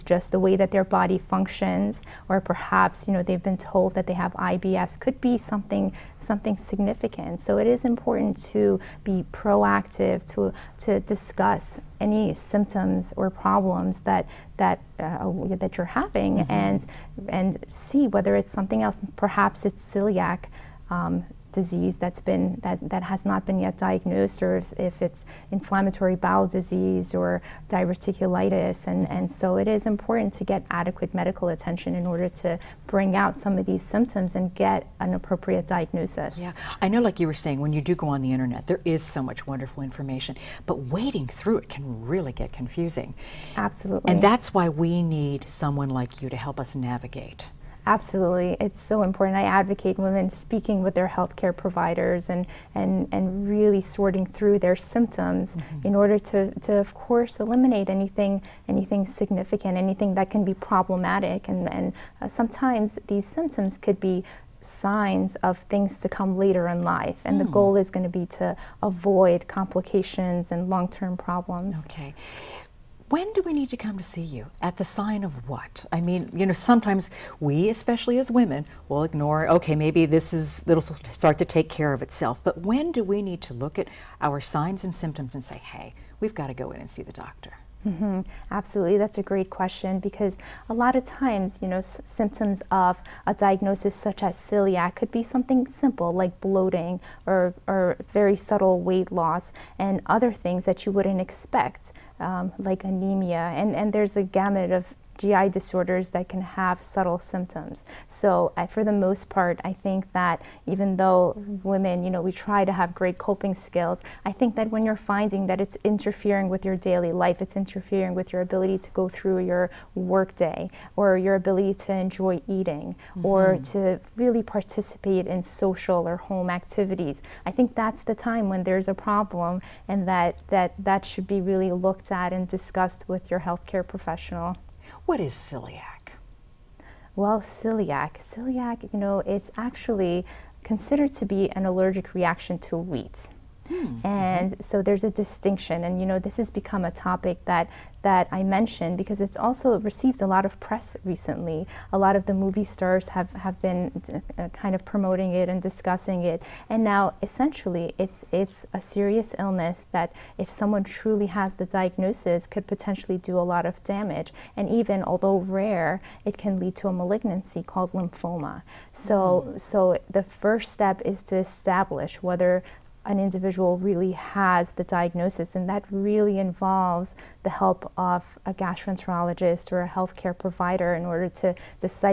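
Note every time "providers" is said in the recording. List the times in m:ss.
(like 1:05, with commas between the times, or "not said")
0:51, 3:00.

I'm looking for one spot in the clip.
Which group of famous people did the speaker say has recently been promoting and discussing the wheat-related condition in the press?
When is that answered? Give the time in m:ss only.
2:32.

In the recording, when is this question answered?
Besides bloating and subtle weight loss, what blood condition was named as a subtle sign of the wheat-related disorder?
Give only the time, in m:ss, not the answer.
1:42.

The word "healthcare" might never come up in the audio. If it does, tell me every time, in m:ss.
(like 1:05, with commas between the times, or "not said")
0:51, 2:13, 2:59.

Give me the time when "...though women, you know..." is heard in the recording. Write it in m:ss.
1:50.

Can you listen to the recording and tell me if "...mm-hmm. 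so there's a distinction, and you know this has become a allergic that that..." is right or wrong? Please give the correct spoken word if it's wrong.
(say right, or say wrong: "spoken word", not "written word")
wrong: "topic", not "allergic".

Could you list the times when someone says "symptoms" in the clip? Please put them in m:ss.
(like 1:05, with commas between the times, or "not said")
0:12, 0:33, 0:54, 1:03, 1:24, 1:32, 1:47.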